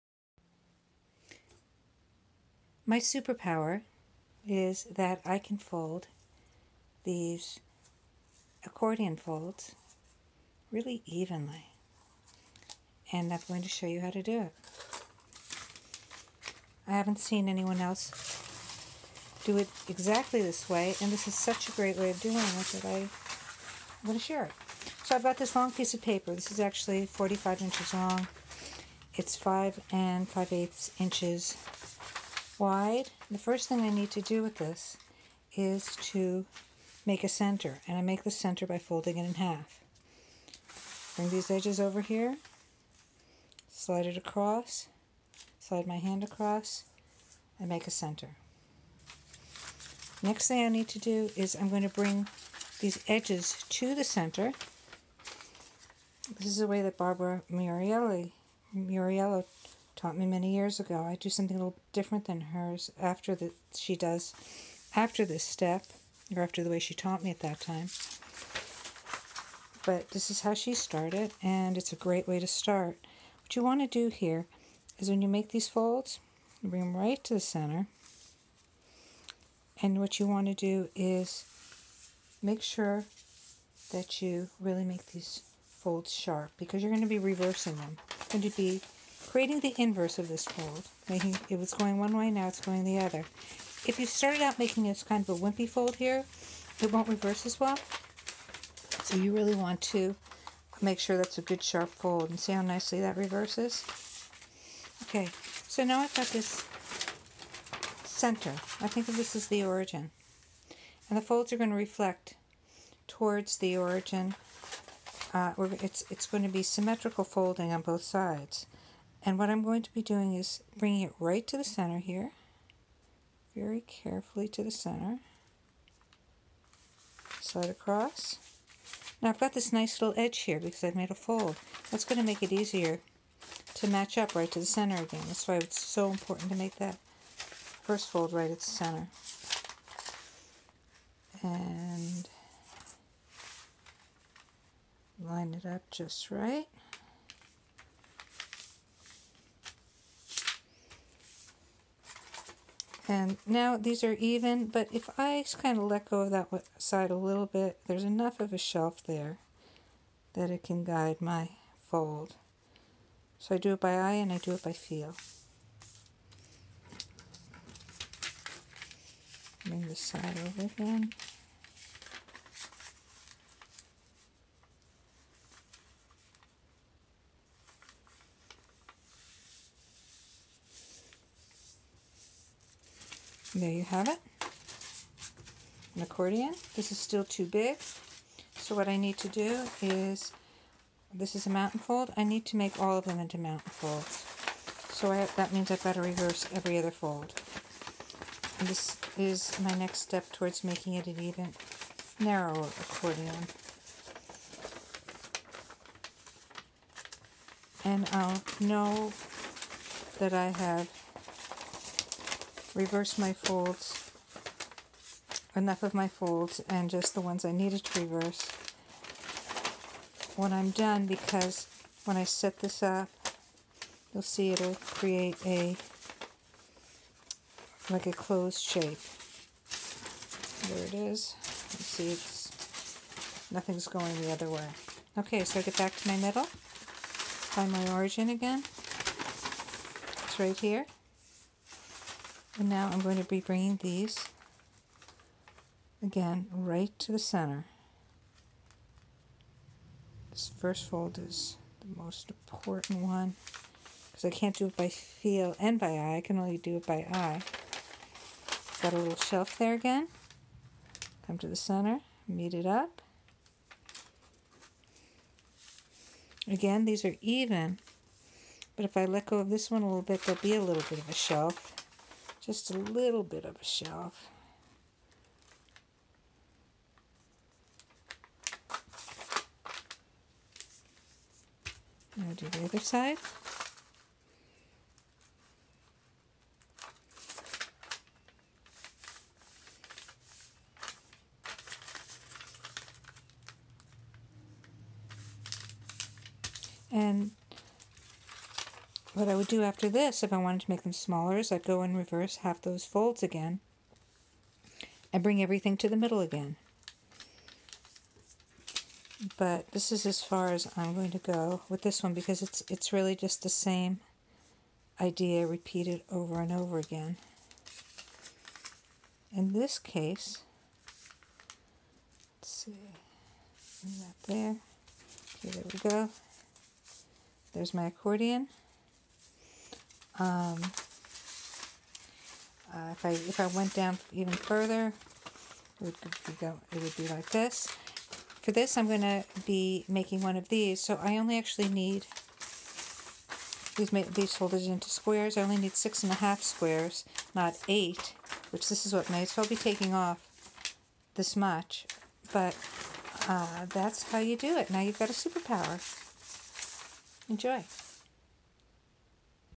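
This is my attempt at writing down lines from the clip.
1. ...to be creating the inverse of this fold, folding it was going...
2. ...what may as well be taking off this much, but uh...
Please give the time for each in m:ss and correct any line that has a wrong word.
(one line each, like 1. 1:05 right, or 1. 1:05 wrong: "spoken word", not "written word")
1. 1:28 wrong: "making", not "folding"
2. 5:48 right.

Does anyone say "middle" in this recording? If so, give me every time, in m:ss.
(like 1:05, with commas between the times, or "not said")
3:56, 5:05.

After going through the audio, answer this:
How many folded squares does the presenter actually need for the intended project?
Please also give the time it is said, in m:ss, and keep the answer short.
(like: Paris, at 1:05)
6.5, at 5:45.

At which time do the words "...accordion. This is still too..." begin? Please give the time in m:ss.
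3:06.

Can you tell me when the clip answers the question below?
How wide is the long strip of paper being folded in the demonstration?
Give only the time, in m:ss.
0:29.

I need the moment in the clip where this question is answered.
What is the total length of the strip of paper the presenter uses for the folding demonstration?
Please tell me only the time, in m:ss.
0:27.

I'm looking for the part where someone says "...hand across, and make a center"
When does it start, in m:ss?
0:45.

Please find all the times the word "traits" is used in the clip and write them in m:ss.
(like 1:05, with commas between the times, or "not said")
not said.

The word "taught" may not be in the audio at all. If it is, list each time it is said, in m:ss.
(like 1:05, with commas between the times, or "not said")
0:59, 1:06.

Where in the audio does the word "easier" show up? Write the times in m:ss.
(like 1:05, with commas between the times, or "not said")
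2:12.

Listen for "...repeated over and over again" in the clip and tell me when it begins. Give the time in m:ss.
5:15.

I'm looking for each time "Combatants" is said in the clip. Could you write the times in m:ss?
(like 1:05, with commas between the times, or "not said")
not said.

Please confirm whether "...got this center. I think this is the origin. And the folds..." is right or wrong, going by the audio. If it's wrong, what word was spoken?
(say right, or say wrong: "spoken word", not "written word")
right.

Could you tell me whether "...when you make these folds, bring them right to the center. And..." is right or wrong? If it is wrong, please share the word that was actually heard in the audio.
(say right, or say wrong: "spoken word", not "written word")
right.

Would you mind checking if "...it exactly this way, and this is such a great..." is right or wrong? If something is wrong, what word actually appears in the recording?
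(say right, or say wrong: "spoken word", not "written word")
right.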